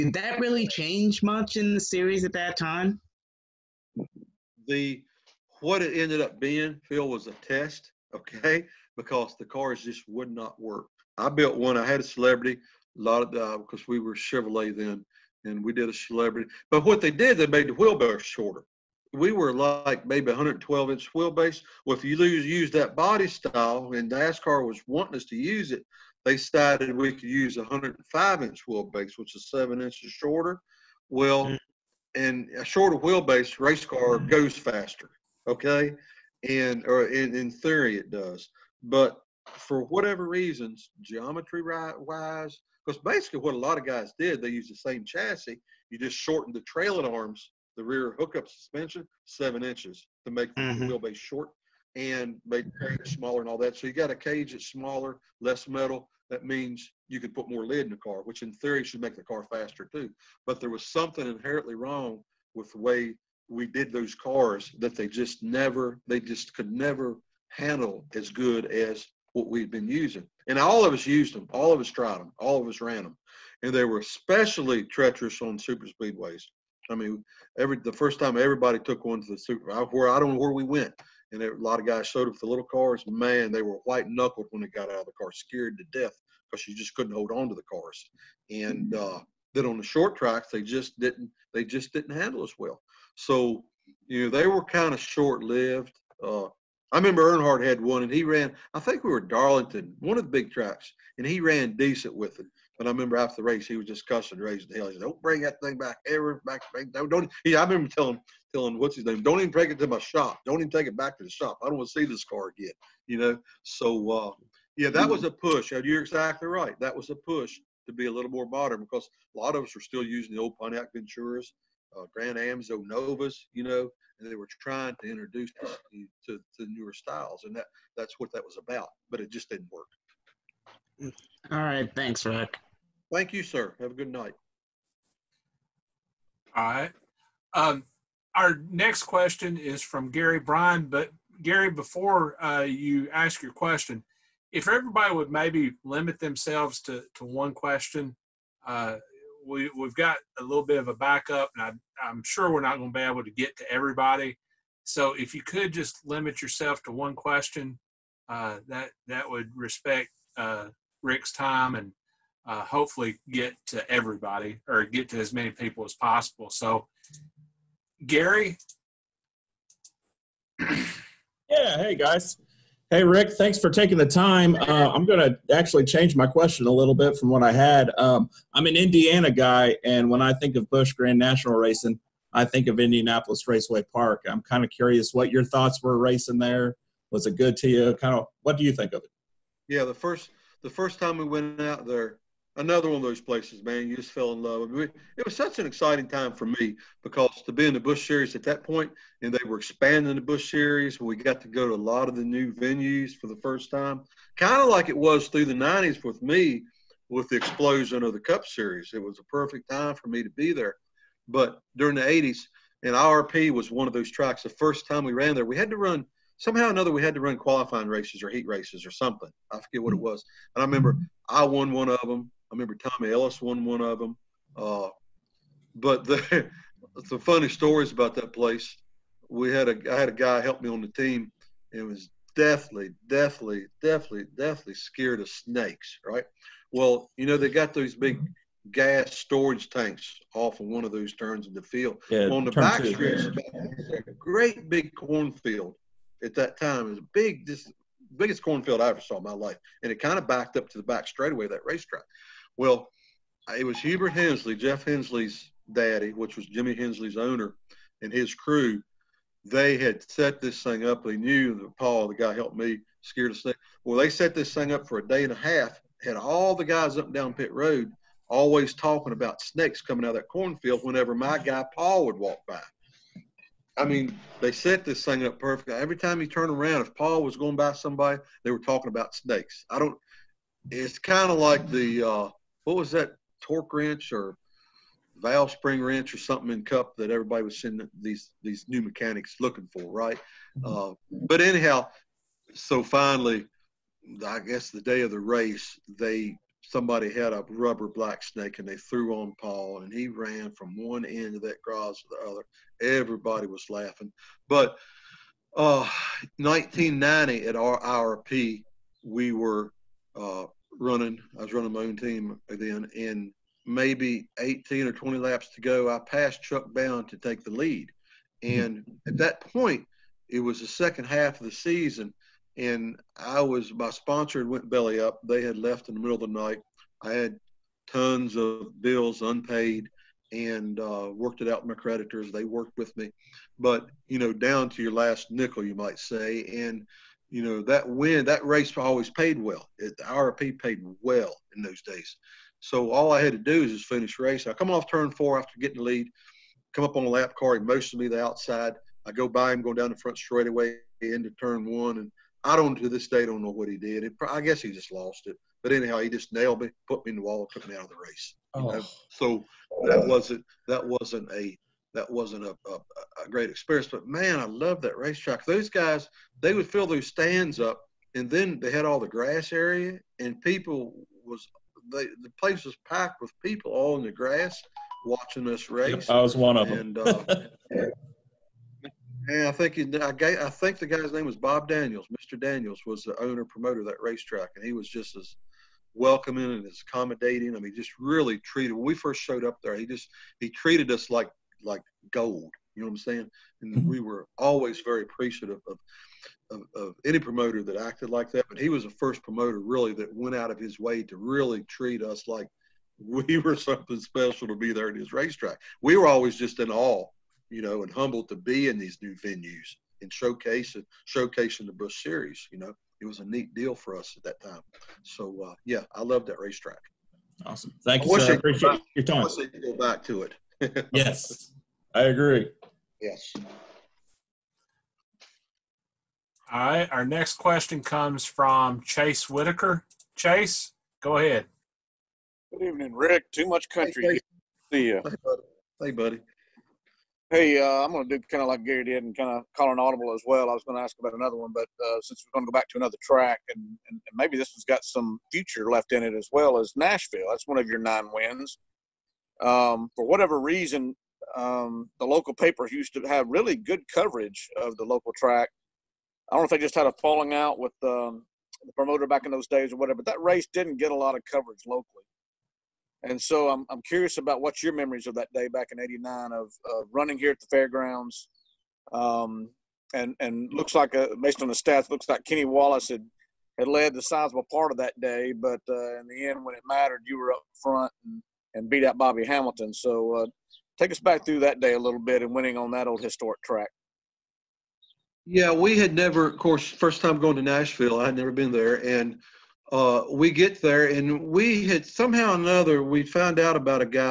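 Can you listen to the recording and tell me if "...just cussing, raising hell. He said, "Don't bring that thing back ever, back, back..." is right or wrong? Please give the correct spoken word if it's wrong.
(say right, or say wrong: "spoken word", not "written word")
right.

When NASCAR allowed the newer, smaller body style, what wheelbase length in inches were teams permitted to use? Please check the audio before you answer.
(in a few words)
105 inches.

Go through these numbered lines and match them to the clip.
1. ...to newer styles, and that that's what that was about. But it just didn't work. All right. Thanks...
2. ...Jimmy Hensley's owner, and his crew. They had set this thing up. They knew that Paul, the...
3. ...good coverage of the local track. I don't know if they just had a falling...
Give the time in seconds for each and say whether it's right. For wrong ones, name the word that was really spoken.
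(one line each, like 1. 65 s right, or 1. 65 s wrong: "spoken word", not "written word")
1. 126 s right
2. 256 s right
3. 453 s right.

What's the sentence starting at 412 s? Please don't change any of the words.
You know, it was a neat deal for us at that time.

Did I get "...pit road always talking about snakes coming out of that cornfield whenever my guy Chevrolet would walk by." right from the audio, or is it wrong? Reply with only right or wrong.
wrong.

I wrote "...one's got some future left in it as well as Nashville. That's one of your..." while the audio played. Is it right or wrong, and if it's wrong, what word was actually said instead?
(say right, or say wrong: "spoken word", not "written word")
right.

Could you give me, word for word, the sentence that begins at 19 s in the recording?
We were like maybe 112 inch wheelbase.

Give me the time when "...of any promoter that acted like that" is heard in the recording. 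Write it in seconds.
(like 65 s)
396 s.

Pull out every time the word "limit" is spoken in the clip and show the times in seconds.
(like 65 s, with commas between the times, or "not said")
145 s, 156 s.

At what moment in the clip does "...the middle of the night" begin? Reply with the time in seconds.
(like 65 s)
325 s.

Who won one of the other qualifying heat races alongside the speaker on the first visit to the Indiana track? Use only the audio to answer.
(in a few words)
Tommy Ellis.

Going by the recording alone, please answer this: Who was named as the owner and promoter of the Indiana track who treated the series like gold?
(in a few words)
Bob Daniels.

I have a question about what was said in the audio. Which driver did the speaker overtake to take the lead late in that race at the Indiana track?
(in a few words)
Chuck Bown.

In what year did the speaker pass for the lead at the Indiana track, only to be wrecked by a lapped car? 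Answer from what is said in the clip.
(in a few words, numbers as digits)
1990.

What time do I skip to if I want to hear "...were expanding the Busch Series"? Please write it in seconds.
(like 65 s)
199 s.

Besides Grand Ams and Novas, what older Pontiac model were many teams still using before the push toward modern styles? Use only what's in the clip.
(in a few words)
Pontiac Venturas.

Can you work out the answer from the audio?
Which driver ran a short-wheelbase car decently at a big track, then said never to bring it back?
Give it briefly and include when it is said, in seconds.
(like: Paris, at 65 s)
Earnhardt, at 97 s.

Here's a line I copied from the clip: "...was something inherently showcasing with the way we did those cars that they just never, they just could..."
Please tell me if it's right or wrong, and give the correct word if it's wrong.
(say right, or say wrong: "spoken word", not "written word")
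wrong: "wrong", not "showcasing".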